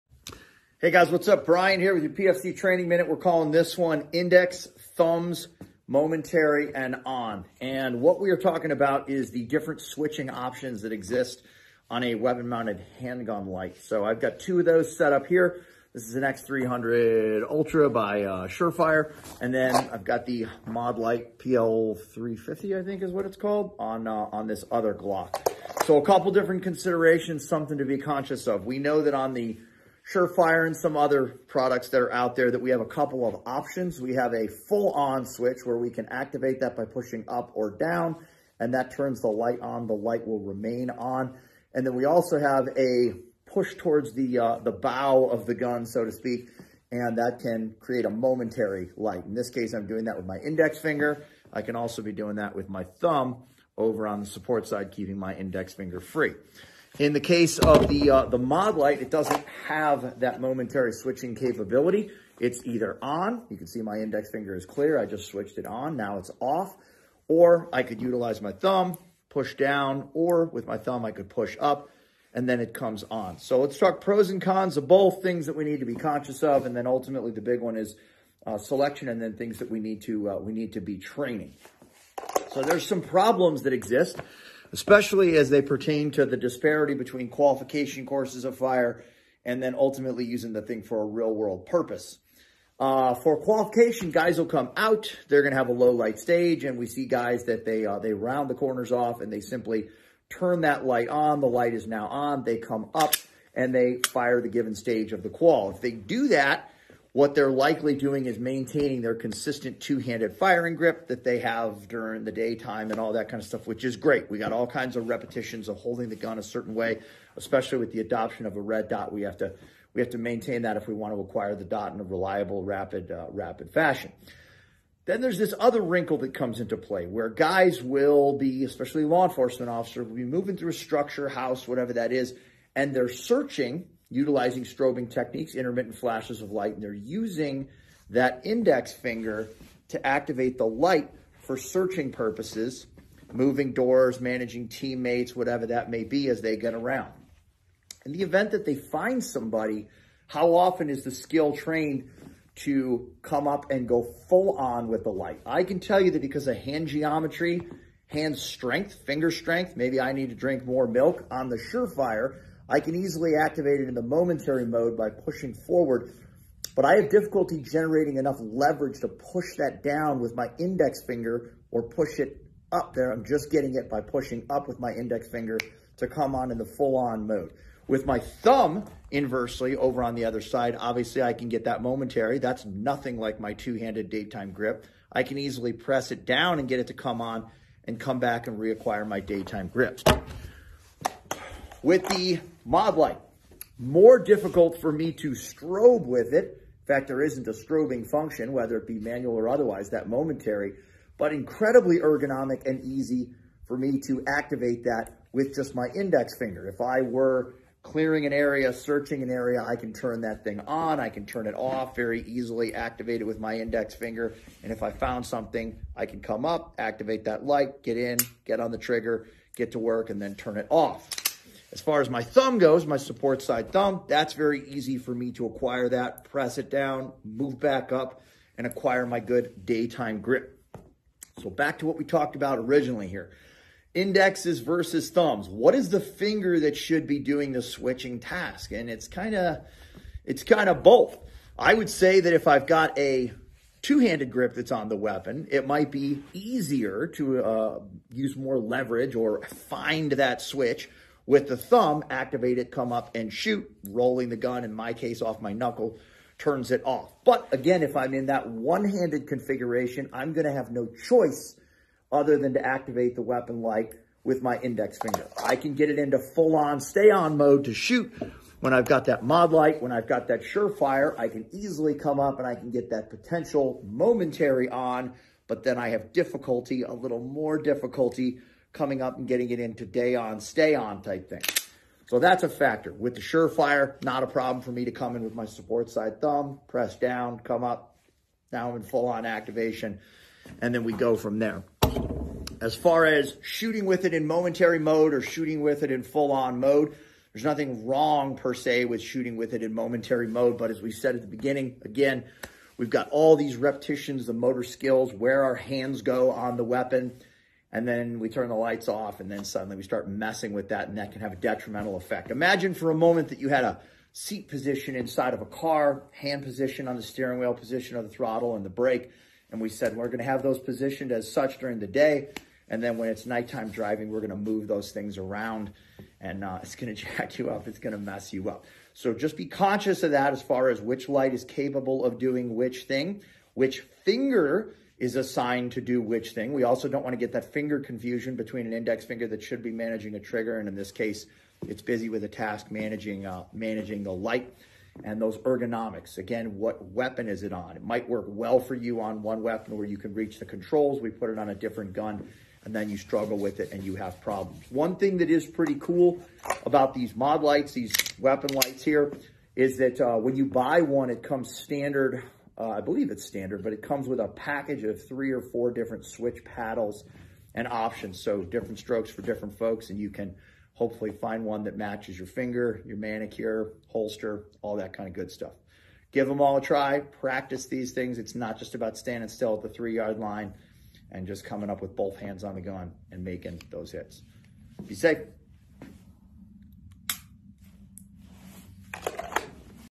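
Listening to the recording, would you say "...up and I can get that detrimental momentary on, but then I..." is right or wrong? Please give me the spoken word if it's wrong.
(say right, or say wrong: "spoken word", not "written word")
wrong: "potential", not "detrimental".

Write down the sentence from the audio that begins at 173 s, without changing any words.
I'm just getting it by pushing up with my index finger to come on in the full on mode.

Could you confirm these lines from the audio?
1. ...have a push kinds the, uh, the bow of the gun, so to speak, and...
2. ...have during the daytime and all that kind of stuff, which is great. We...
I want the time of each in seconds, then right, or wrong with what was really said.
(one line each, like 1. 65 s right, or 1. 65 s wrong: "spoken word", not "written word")
1. 42 s wrong: "towards", not "kinds"
2. 111 s right.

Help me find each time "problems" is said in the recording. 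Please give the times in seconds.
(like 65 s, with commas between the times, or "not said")
83 s, 284 s, 354 s.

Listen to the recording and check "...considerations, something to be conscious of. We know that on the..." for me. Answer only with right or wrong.
right.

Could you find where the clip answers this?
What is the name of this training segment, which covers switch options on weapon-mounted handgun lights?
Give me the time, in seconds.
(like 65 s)
4 s.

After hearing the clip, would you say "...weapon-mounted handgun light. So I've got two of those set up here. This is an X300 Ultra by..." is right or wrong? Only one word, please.
right.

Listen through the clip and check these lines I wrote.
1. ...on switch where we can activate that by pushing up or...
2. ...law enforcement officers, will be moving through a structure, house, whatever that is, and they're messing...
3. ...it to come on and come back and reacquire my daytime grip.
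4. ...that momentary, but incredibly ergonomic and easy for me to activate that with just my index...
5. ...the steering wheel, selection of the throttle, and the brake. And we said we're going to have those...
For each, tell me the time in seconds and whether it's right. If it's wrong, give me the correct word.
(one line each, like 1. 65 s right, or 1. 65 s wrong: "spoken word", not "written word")
1. 34 s right
2. 129 s wrong: "searching", not "messing"
3. 186 s right
4. 199 s right
5. 316 s wrong: "position", not "selection".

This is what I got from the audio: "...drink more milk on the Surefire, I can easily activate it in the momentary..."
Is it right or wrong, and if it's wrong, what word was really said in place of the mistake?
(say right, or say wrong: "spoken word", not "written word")
right.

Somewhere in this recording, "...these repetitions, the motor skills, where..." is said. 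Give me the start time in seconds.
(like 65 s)
303 s.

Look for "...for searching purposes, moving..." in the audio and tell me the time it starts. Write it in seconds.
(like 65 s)
141 s.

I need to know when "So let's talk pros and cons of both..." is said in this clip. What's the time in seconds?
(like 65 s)
73 s.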